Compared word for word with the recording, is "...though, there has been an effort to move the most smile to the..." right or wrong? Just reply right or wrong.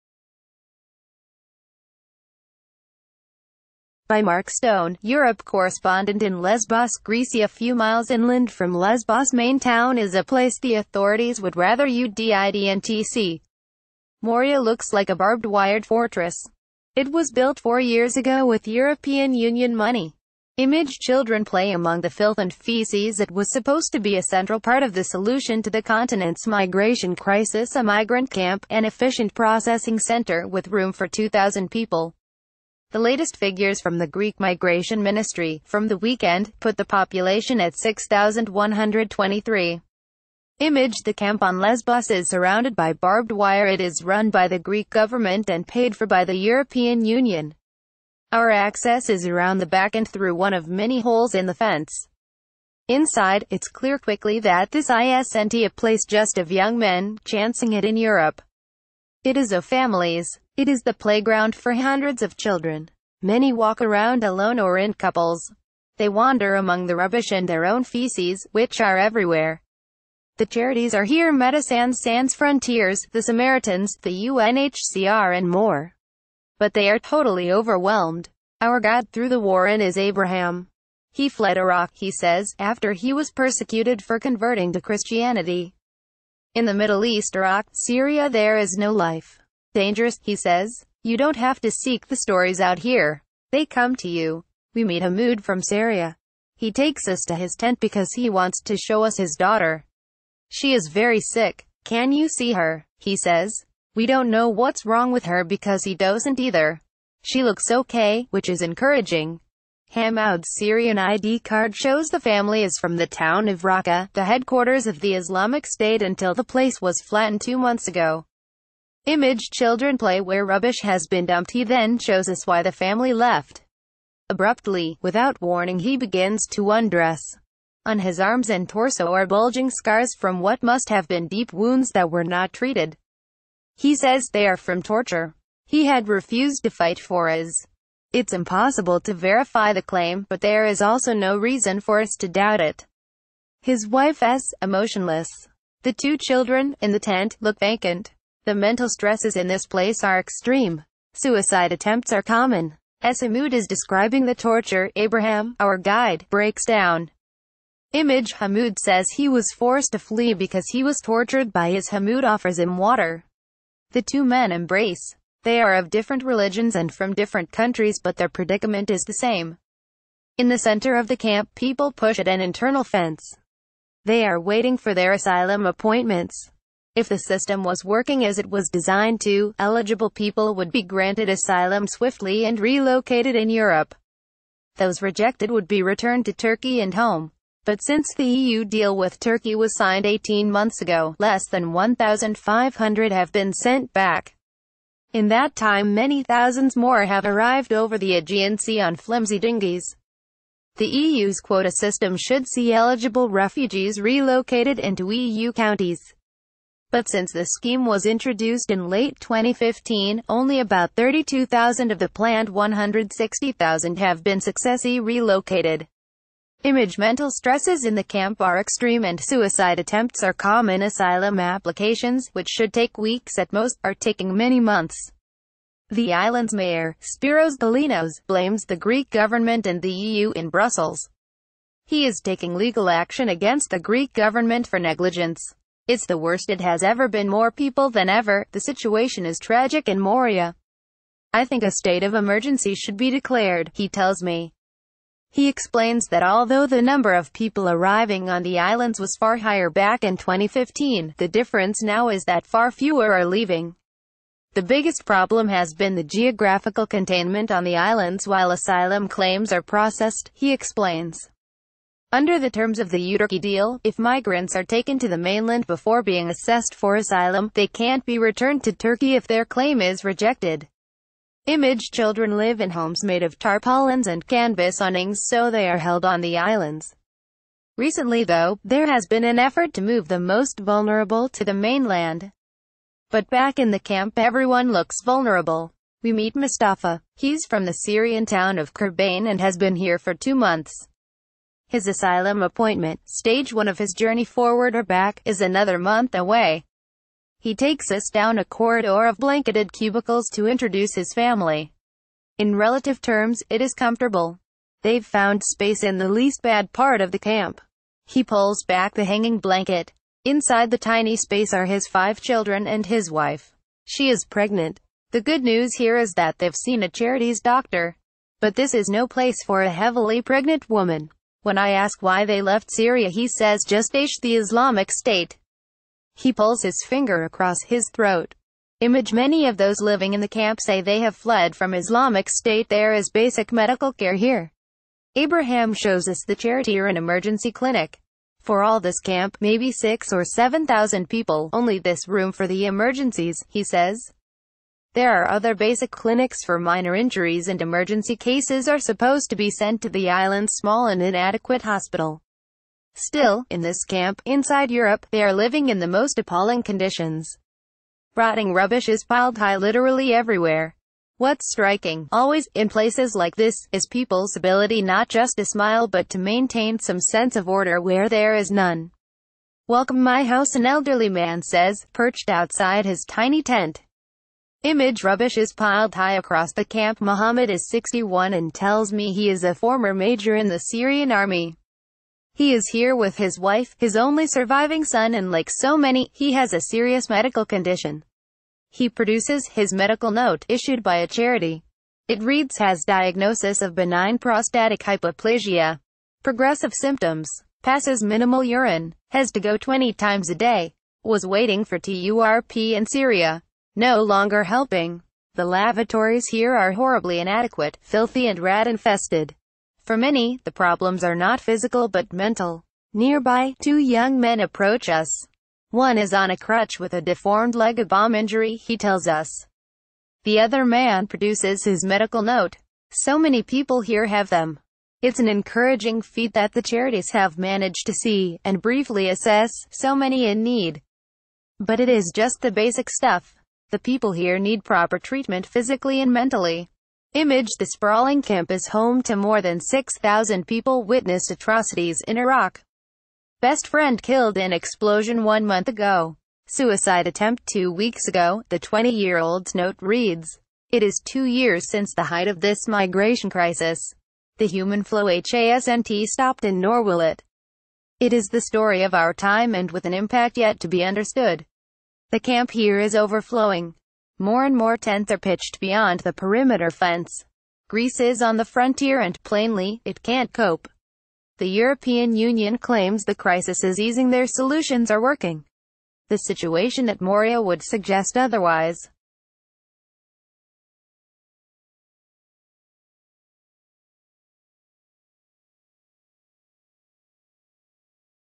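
wrong.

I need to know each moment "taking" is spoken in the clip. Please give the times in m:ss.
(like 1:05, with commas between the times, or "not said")
3:43, 3:52.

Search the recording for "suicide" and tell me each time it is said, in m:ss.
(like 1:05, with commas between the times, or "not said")
2:31, 3:39, 7:26.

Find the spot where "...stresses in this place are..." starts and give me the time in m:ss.
2:28.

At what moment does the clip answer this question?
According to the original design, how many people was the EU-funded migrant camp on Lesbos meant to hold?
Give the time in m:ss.
0:31.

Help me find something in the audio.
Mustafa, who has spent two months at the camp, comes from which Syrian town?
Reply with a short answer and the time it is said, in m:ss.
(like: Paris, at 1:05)
Kurban, at 4:48.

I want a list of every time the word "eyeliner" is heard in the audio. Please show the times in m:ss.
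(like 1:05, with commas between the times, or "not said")
not said.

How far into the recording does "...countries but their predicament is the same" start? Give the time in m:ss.
2:47.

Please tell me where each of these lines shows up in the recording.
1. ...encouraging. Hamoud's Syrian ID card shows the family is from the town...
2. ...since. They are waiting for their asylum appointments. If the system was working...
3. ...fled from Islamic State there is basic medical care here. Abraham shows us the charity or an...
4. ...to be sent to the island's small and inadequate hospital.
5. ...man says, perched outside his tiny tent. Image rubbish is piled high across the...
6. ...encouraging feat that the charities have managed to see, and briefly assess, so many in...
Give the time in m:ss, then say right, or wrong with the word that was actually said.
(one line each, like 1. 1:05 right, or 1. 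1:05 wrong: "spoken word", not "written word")
1. 1:48 right
2. 2:52 wrong: "fence", not "since"
3. 5:31 right
4. 5:49 right
5. 6:11 right
6. 7:05 right.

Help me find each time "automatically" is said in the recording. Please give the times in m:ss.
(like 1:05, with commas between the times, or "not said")
not said.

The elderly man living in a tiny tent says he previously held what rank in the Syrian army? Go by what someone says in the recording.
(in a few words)
major.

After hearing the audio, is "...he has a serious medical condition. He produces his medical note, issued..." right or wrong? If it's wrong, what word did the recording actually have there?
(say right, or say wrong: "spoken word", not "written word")
right.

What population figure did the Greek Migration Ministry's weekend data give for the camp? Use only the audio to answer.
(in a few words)
6,123.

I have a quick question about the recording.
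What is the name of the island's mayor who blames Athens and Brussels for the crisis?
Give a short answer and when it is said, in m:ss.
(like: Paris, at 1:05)
Spiros Galinos, at 3:46.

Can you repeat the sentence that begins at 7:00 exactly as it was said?
The other man produces his medical note.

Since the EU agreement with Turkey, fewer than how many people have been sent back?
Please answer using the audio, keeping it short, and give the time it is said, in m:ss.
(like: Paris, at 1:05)
1,500, at 3:11.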